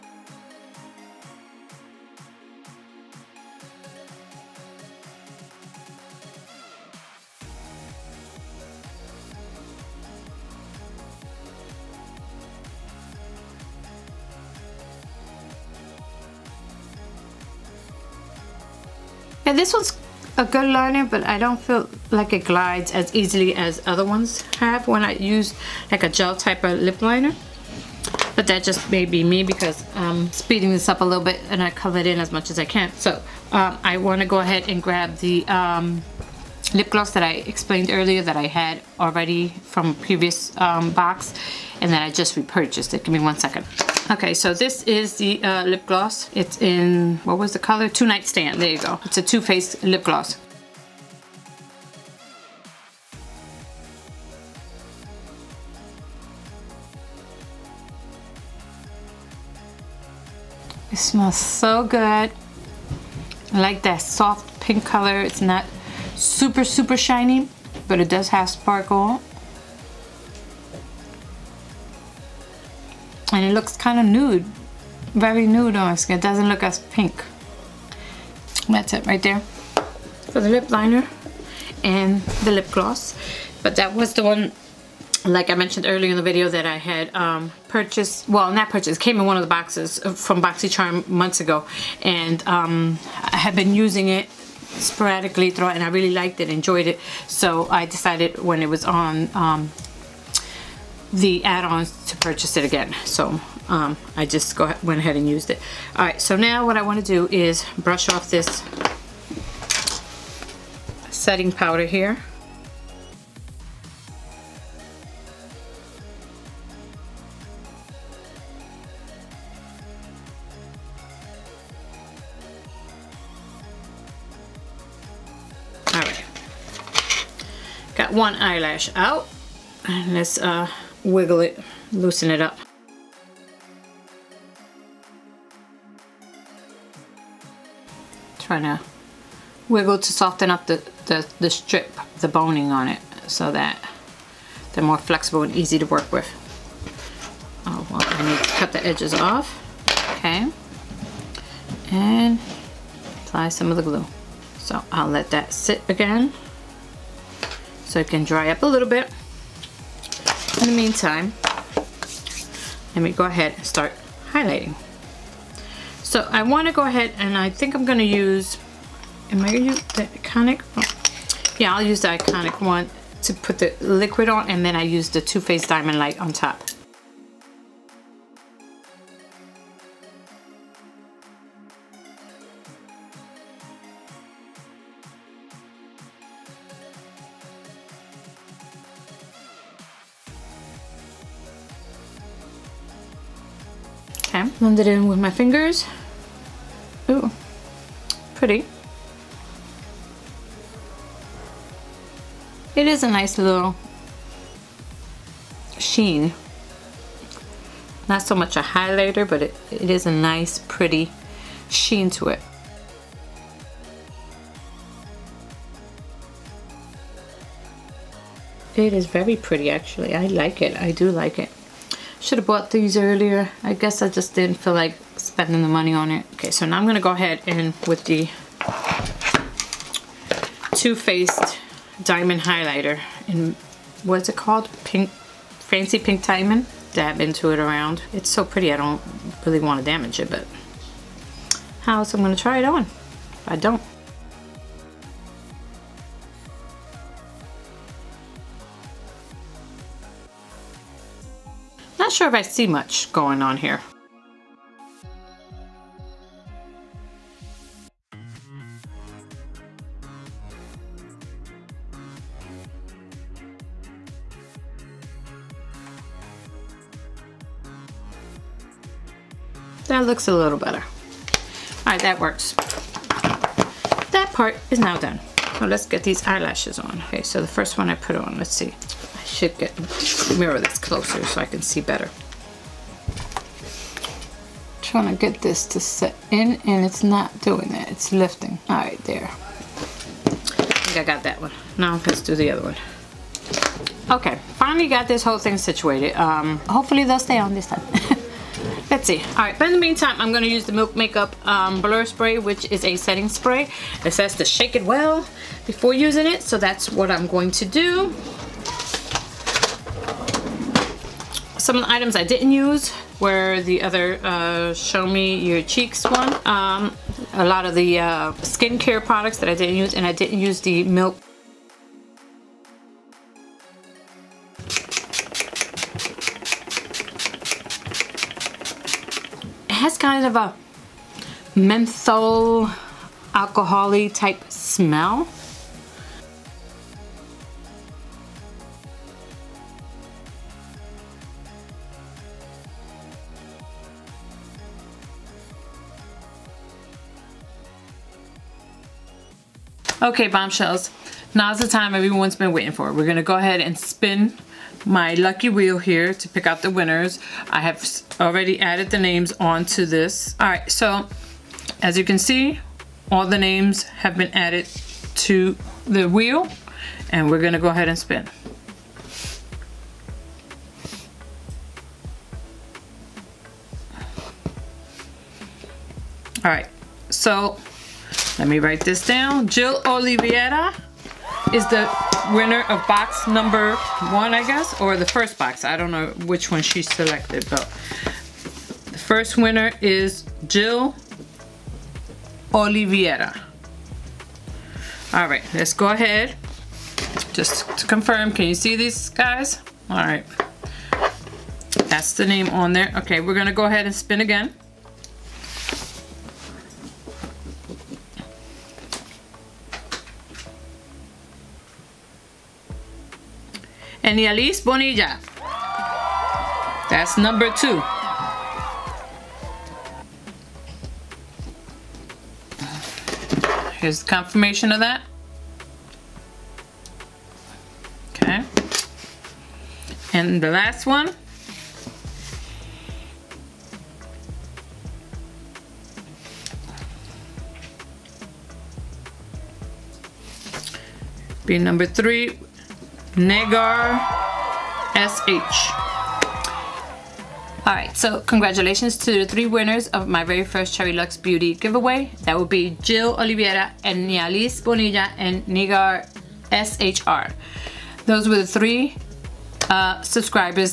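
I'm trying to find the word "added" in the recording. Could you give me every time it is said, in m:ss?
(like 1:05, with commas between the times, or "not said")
5:58, 6:04.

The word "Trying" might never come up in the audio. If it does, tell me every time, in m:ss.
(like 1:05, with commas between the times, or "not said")
2:18, 4:44.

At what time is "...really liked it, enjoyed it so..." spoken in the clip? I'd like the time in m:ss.
1:35.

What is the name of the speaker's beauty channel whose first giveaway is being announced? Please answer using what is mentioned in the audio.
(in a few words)
Cherrylux Beauty.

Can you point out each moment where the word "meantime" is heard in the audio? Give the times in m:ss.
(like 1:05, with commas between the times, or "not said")
2:40, 4:59.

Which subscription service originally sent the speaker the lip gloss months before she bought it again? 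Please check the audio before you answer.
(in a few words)
BoxyCharm.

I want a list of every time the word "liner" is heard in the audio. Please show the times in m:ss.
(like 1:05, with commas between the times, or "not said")
0:20, 0:27, 1:20.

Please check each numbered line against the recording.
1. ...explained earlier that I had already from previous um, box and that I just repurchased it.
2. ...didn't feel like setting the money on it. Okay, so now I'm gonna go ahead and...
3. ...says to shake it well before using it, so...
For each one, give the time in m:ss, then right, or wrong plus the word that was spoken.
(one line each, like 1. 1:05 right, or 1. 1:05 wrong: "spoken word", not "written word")
1. 0:37 right
2. 3:44 wrong: "spending", not "setting"
3. 5:04 right.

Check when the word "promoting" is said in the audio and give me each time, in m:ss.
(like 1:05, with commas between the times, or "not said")
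not said.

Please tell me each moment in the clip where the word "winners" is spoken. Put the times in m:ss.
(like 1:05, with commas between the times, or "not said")
5:56, 6:22, 6:29, 7:29.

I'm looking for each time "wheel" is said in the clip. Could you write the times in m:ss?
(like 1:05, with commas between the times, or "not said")
5:55, 6:06.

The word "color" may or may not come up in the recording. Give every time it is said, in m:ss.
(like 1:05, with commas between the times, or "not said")
0:47, 1:04.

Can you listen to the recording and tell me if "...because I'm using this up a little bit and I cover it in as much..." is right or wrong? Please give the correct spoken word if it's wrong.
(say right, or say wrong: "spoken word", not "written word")
wrong: "speeding", not "using".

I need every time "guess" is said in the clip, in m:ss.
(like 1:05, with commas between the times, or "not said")
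3:43, 6:24.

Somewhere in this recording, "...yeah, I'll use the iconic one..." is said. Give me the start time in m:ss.
2:51.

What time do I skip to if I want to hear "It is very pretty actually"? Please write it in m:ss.
3:38.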